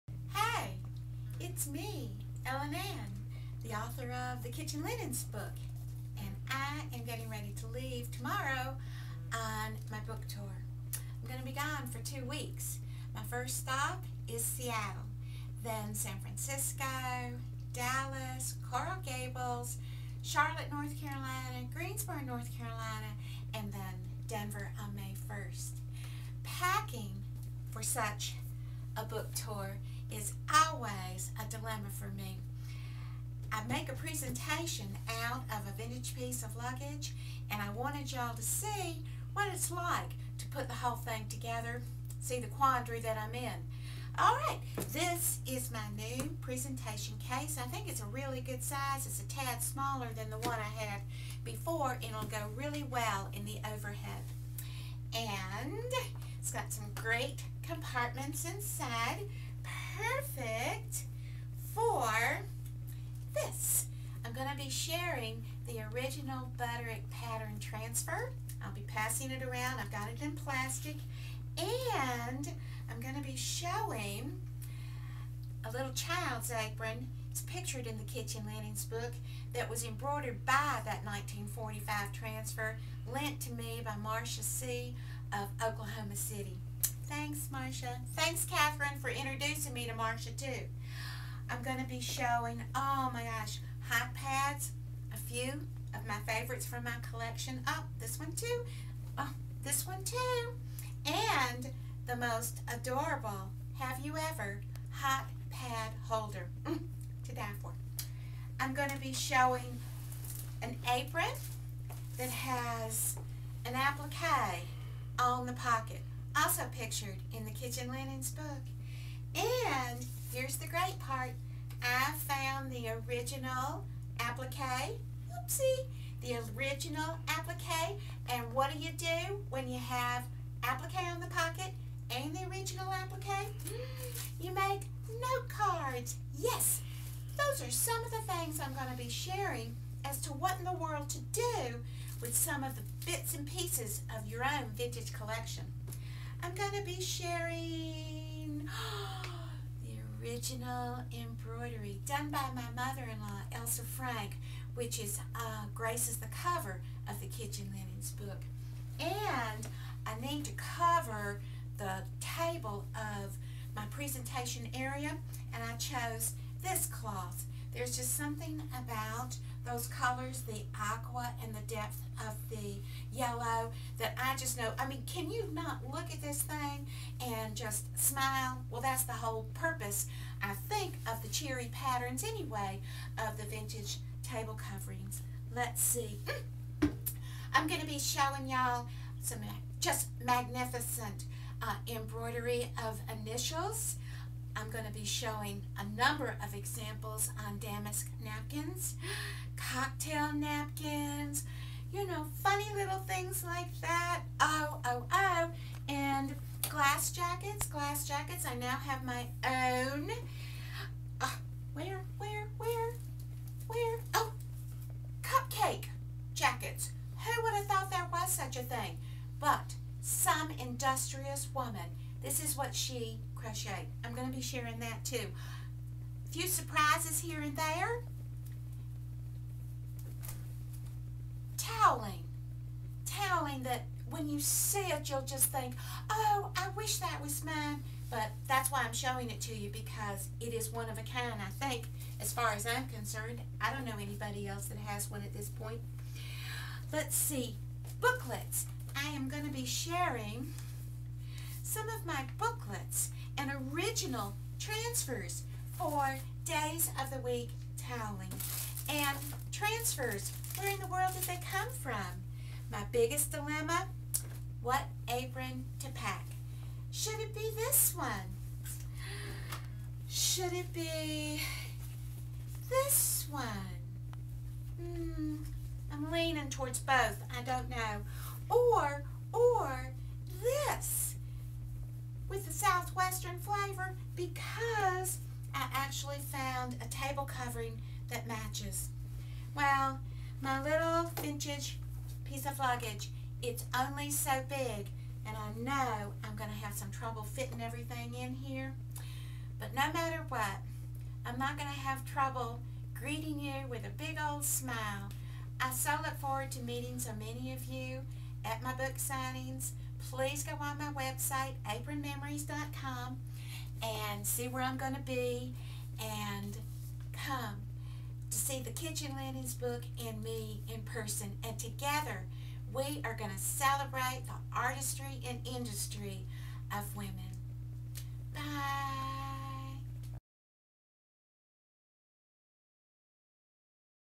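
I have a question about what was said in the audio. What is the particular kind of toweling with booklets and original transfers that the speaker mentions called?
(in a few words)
Days of the Week.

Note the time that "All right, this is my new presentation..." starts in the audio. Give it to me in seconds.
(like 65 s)
44 s.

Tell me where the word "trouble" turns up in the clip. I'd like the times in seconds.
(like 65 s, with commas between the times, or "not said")
296 s, 302 s.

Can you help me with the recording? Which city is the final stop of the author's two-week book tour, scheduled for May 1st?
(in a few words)
Denver.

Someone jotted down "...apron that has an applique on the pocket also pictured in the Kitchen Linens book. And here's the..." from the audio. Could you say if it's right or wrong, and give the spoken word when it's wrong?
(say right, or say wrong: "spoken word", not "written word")
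right.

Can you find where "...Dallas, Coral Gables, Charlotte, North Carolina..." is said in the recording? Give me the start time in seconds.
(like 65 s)
17 s.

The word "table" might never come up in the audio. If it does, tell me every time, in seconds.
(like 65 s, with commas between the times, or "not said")
162 s, 184 s, 286 s.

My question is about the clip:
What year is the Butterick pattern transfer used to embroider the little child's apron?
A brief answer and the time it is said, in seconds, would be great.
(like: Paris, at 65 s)
1945, at 81 s.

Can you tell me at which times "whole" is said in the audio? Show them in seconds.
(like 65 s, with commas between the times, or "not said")
40 s, 179 s.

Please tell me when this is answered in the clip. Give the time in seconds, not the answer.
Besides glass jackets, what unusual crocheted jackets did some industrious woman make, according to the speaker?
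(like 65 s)
215 s.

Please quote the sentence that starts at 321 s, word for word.
And together, we are going to celebrate the artistry and industry of women.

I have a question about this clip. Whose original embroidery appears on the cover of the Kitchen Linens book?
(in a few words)
Elsa Frank.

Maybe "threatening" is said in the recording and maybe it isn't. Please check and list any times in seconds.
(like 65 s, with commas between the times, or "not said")
not said.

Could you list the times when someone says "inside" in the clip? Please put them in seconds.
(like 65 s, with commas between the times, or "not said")
58 s.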